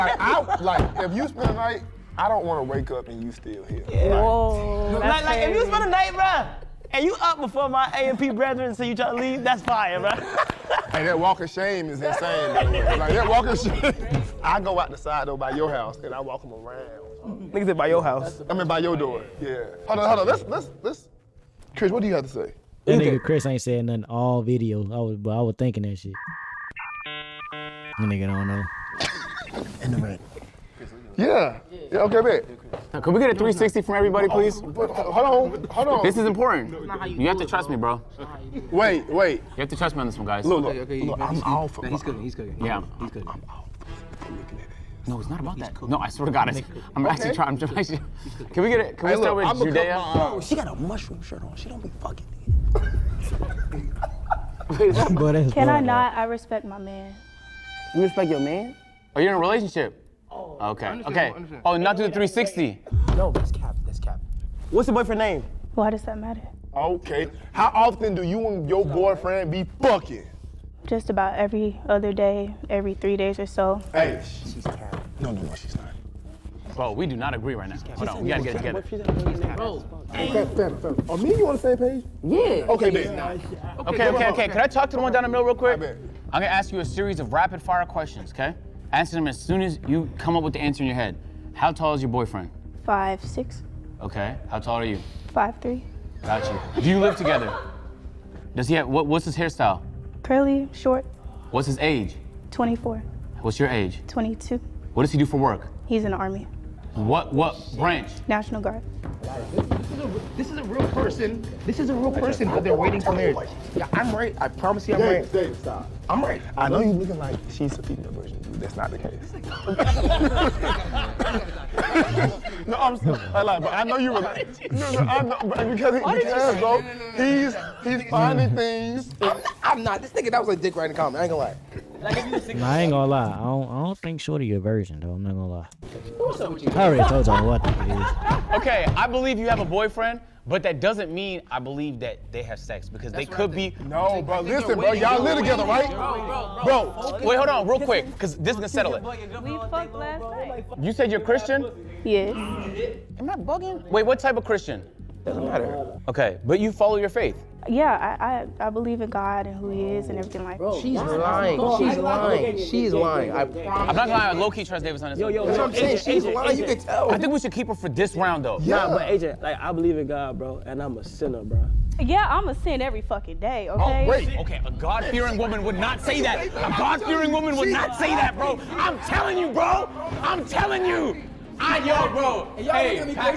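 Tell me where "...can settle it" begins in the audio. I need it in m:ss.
2:28.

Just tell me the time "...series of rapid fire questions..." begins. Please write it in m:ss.
1:26.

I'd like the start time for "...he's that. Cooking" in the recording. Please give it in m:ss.
0:45.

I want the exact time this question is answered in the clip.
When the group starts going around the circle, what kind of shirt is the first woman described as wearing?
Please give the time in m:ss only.
0:50.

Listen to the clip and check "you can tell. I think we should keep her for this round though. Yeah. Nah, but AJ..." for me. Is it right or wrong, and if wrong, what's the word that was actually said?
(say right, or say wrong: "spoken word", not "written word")
right.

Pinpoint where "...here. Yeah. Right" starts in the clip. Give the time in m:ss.
0:03.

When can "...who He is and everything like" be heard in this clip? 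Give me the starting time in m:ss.
2:39.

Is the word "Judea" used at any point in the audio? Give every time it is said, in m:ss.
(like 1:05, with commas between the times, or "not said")
0:49.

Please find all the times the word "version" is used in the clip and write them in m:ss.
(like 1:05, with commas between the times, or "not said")
1:58, 2:14.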